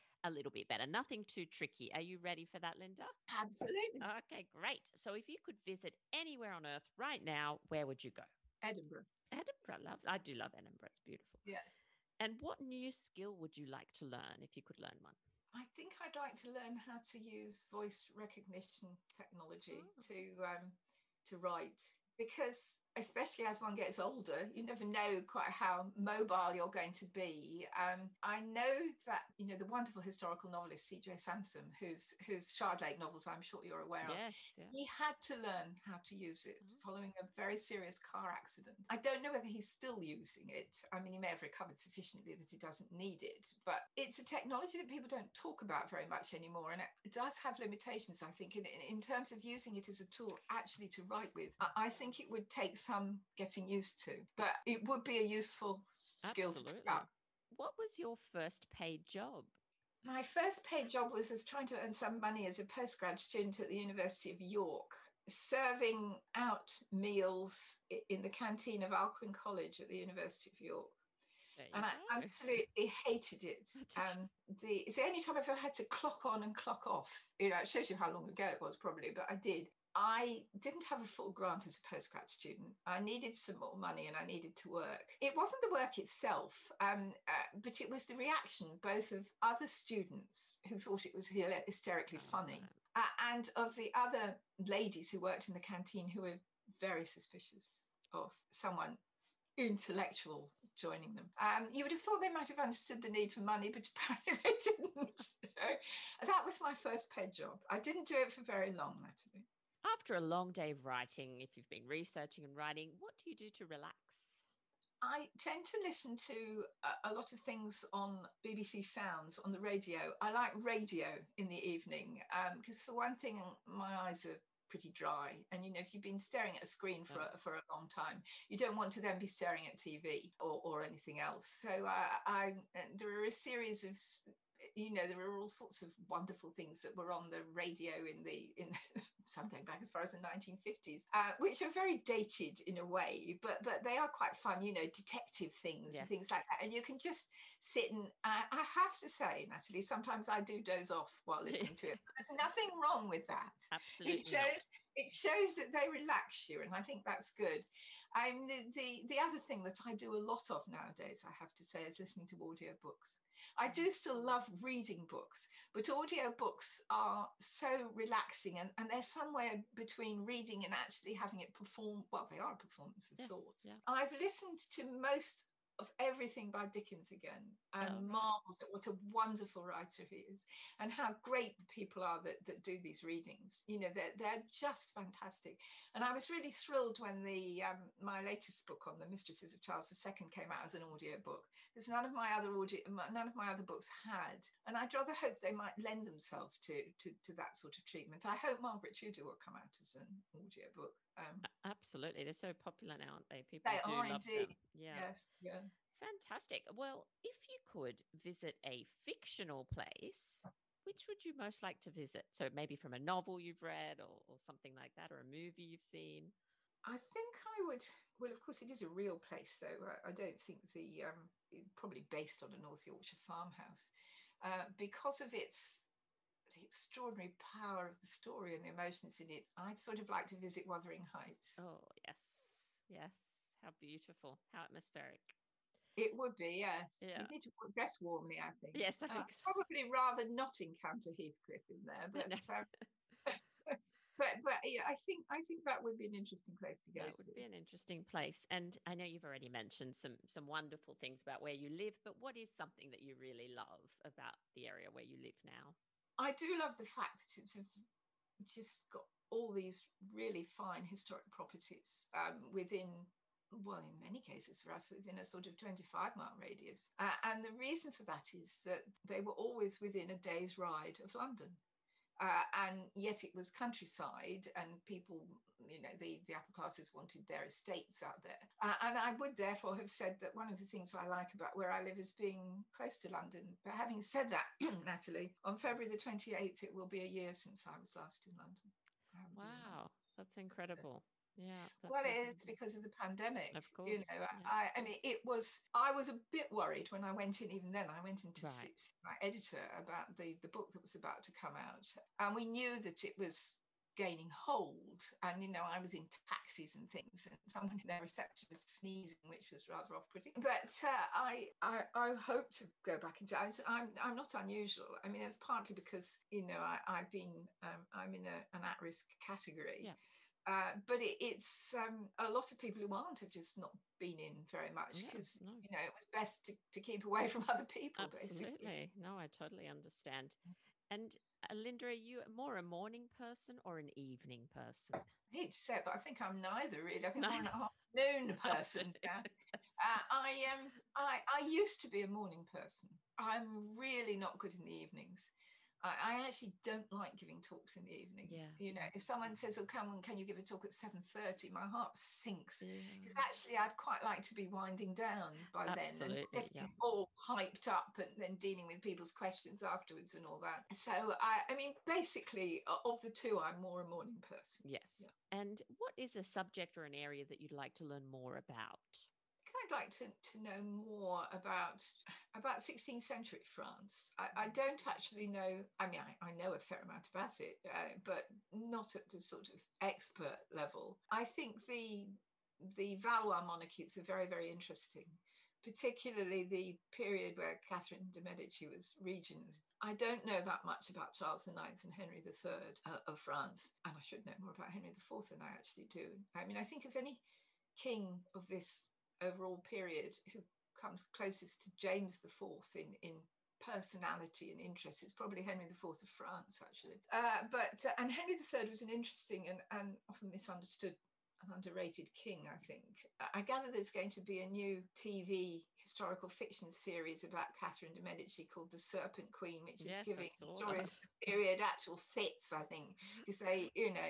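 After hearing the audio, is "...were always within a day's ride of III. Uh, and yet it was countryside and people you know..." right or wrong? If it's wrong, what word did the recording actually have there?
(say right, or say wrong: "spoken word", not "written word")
wrong: "London", not "III".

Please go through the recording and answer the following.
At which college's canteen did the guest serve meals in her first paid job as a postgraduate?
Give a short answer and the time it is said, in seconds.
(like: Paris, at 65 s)
Alcuin College, at 68 s.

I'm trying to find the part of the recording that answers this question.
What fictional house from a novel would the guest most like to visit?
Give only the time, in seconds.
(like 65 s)
230 s.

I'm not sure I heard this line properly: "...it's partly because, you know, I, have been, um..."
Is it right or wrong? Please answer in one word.
right.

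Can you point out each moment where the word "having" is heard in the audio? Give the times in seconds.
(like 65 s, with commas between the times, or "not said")
171 s, 283 s.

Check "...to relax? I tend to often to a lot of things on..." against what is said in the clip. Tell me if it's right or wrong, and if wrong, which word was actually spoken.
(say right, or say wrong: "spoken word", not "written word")
wrong: "listen", not "often".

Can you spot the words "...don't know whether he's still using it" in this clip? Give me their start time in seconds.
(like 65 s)
38 s.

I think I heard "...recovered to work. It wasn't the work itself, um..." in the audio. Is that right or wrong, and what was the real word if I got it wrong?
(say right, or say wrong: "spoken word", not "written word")
wrong: "needed", not "recovered".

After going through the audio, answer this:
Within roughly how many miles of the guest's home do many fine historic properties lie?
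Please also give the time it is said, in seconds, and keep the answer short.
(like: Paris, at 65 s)
25, at 265 s.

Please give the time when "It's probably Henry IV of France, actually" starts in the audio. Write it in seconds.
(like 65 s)
405 s.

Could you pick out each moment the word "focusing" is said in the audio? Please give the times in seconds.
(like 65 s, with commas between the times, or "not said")
not said.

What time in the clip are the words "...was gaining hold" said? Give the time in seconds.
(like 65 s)
303 s.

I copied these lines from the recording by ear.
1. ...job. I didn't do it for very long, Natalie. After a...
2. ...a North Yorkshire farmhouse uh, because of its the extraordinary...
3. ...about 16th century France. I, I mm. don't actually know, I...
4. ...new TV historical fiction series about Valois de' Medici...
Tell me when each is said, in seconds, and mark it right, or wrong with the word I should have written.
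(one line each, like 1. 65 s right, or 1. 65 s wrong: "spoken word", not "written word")
1. 107 s right
2. 222 s right
3. 372 s right
4. 414 s wrong: "Catherine", not "Valois".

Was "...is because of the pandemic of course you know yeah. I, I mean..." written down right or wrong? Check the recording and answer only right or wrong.
right.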